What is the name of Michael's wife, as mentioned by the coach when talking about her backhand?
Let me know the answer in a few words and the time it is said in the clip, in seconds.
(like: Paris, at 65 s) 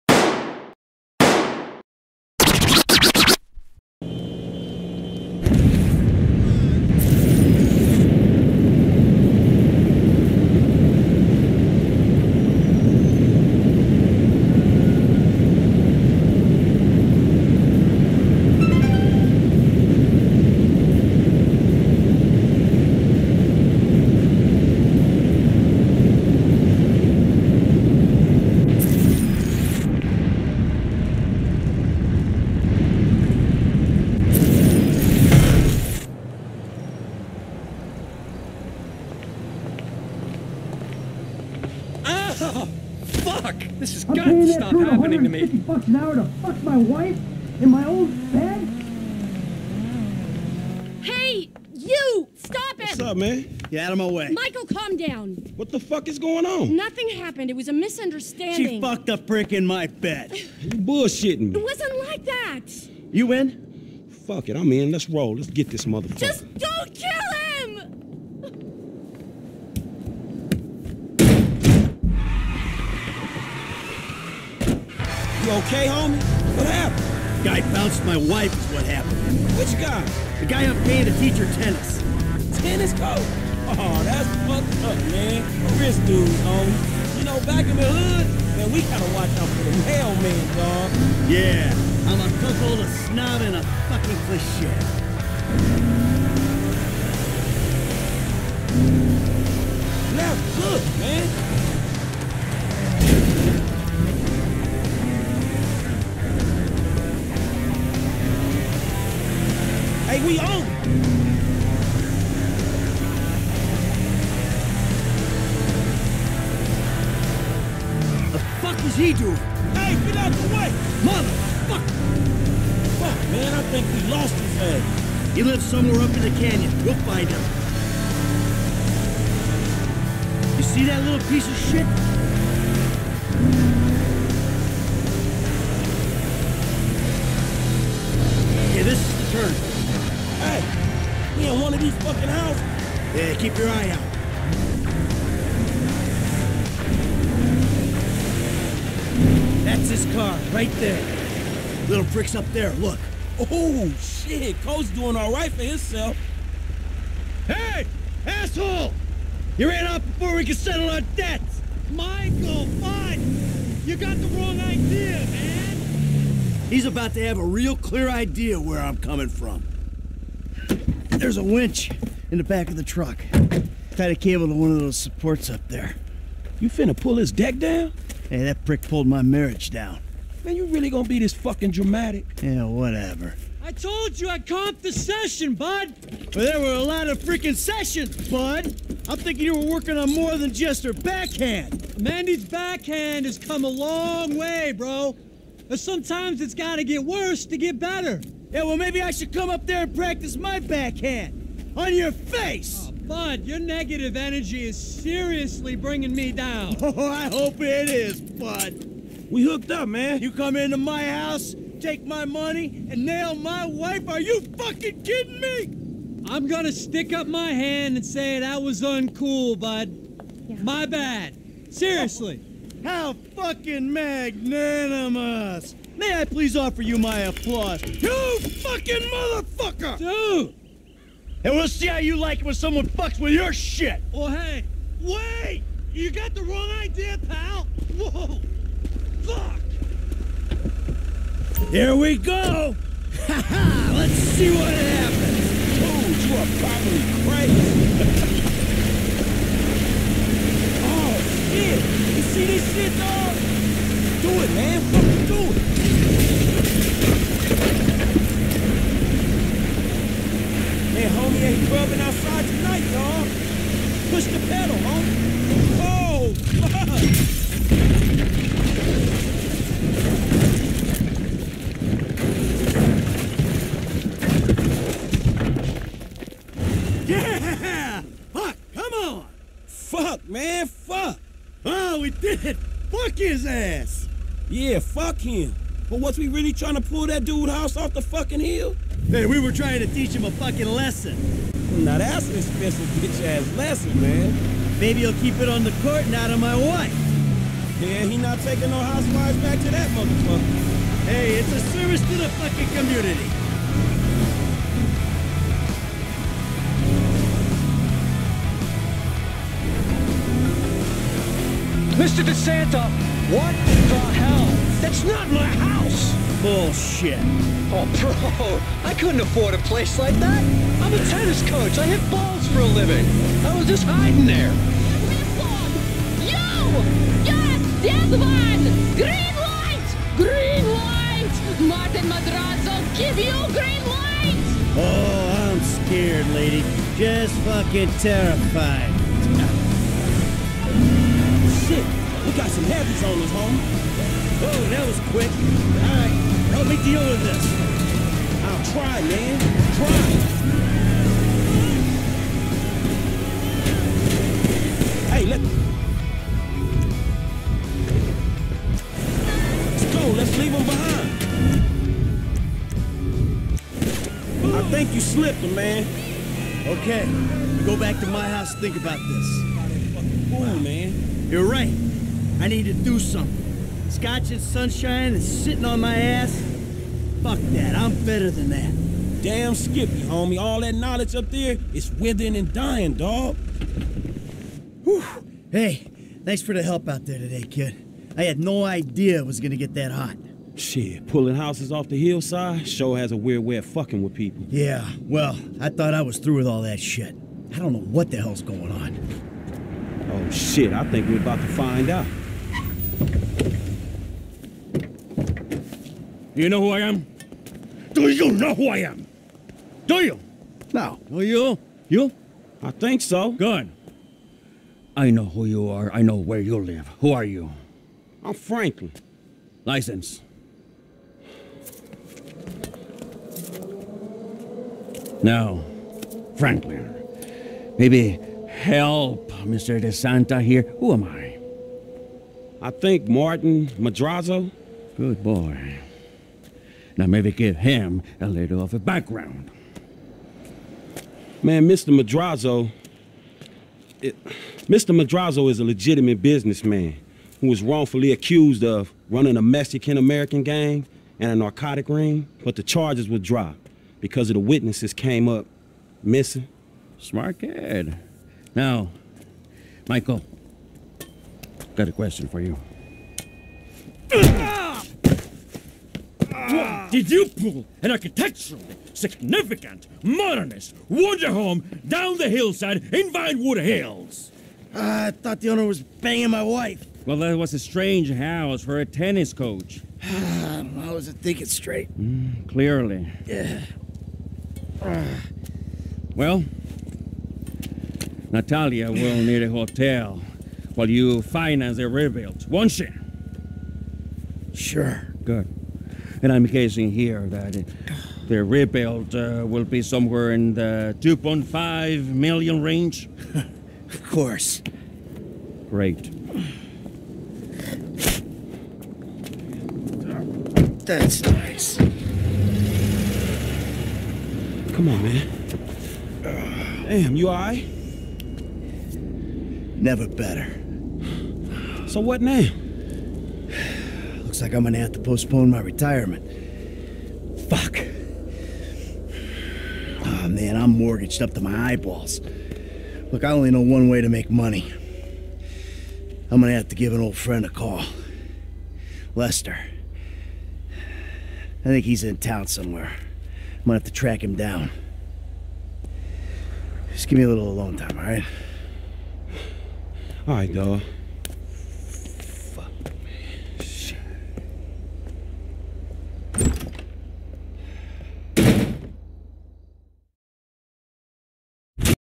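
Mandy, at 192 s.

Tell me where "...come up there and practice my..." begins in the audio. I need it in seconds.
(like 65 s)
199 s.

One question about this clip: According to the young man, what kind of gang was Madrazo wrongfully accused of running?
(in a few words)
Mexican American gang.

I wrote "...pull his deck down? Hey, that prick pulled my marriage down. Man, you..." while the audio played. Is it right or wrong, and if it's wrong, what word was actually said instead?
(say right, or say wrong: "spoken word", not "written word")
right.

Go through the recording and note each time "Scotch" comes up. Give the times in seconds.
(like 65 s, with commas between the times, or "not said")
373 s.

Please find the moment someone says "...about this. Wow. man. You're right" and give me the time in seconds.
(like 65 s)
368 s.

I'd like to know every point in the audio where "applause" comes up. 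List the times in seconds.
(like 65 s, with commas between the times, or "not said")
227 s.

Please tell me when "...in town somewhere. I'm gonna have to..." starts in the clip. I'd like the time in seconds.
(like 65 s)
542 s.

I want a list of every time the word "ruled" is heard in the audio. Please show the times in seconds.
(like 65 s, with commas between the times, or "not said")
not said.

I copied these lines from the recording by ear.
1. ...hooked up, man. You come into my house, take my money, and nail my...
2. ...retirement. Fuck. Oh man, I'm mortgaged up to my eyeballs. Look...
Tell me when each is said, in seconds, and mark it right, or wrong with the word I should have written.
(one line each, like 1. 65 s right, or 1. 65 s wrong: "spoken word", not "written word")
1. 209 s right
2. 525 s right.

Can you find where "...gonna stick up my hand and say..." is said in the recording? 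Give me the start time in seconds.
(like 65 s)
216 s.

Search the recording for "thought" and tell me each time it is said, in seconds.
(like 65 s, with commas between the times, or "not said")
395 s, 475 s.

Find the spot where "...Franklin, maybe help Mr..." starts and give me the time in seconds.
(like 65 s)
426 s.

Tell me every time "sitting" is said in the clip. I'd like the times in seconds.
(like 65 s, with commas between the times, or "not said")
375 s.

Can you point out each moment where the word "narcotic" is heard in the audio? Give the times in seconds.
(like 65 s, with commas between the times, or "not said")
451 s.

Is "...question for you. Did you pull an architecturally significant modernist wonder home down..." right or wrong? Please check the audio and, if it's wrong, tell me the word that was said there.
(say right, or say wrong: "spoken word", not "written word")
right.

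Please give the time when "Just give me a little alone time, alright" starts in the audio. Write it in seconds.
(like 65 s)
546 s.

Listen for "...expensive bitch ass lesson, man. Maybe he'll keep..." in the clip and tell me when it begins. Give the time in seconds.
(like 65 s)
292 s.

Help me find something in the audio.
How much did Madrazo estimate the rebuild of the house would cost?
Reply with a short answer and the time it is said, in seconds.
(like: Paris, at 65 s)
2.5 million, at 500 s.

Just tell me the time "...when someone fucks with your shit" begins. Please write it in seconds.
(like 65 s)
232 s.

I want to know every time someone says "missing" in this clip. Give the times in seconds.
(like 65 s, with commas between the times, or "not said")
456 s.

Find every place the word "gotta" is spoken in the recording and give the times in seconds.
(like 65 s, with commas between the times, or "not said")
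88 s, 196 s.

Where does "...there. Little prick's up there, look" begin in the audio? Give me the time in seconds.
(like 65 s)
150 s.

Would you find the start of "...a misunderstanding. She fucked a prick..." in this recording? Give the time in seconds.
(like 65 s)
57 s.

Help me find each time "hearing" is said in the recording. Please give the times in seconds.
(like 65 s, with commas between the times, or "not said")
not said.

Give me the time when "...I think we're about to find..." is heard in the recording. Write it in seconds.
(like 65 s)
400 s.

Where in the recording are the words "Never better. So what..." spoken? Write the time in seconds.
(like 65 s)
519 s.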